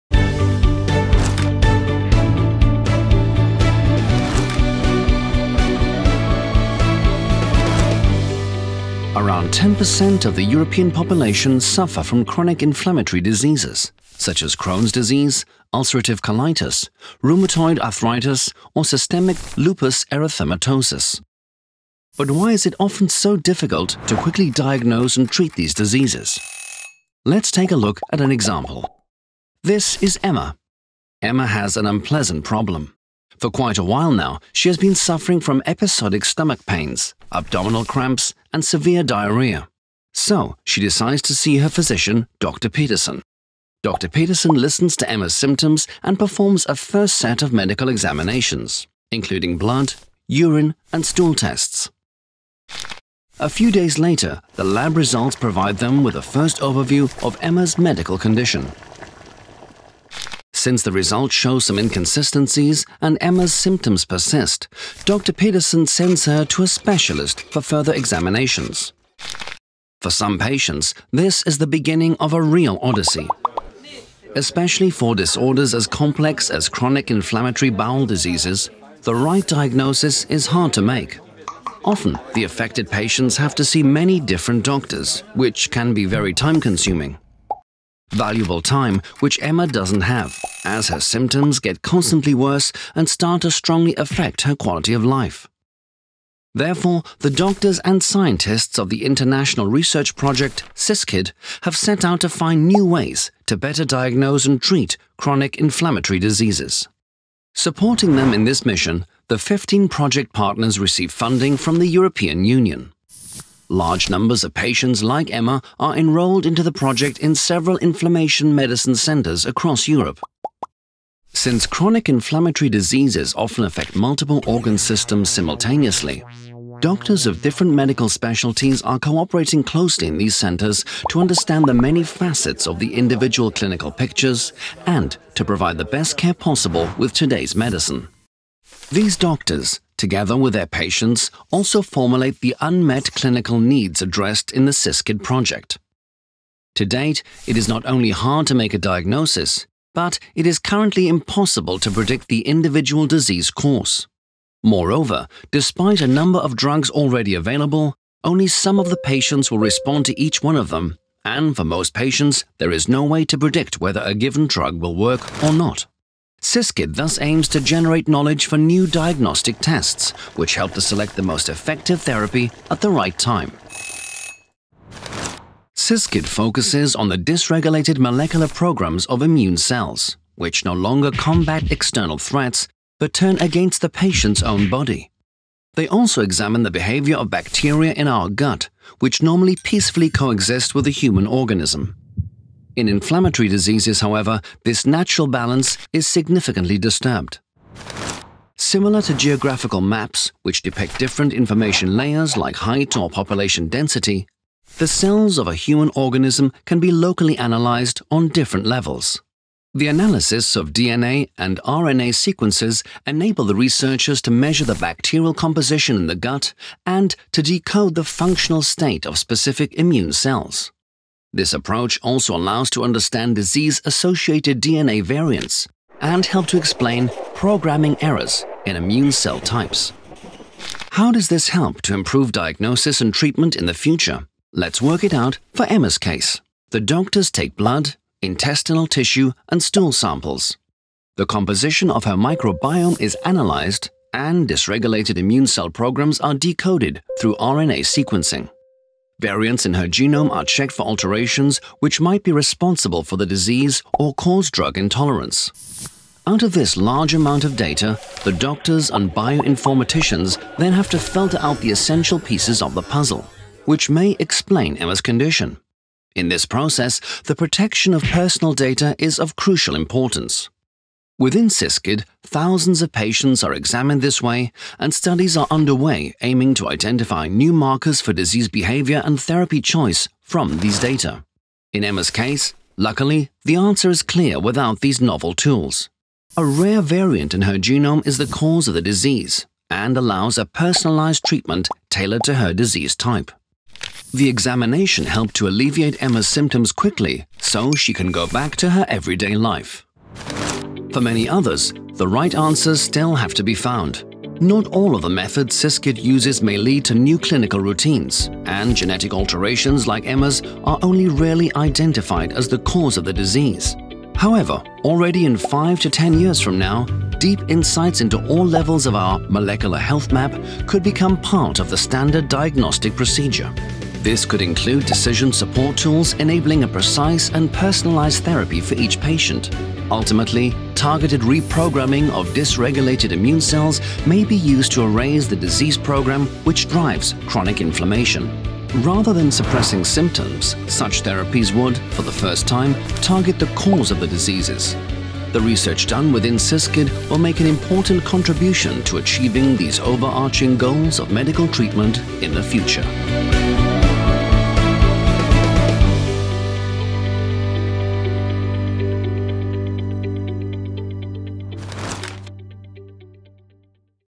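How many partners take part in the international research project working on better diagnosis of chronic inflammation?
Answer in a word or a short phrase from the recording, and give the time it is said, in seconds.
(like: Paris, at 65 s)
15, at 109 s.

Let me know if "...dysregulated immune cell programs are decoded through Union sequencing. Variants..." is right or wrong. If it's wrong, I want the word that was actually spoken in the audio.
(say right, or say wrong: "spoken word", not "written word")
wrong: "RNA", not "Union".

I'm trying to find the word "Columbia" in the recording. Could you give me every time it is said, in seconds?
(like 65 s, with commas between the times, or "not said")
not said.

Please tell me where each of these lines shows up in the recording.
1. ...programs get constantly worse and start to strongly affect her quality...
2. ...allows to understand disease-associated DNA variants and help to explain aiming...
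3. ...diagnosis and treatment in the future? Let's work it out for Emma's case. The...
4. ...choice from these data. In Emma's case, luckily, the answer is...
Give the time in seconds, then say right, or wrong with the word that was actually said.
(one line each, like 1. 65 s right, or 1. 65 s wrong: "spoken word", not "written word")
1. 90 s wrong: "symptoms", not "programs"
2. 222 s wrong: "programming", not "aiming"
3. 232 s right
4. 279 s right.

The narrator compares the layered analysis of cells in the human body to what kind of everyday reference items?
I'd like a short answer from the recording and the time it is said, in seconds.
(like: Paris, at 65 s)
Geographical maps, at 199 s.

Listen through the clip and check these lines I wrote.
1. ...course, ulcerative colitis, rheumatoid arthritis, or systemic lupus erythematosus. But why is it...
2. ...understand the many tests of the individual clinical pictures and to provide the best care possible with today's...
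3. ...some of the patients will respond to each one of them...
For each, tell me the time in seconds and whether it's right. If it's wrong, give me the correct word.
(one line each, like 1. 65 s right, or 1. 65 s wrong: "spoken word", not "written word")
1. 14 s wrong: "disease", not "course"
2. 131 s wrong: "facets", not "tests"
3. 158 s right.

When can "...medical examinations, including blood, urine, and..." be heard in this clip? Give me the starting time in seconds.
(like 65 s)
47 s.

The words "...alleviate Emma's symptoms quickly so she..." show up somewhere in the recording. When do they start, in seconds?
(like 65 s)
295 s.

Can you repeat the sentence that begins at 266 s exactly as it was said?
In this process, the protection of personal data is of crucial importance.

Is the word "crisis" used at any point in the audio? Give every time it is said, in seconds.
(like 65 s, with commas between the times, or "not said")
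not said.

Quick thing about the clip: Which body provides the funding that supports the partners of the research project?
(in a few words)
The European Union.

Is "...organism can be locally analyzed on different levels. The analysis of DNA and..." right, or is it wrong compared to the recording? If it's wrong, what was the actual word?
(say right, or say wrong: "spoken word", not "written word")
right.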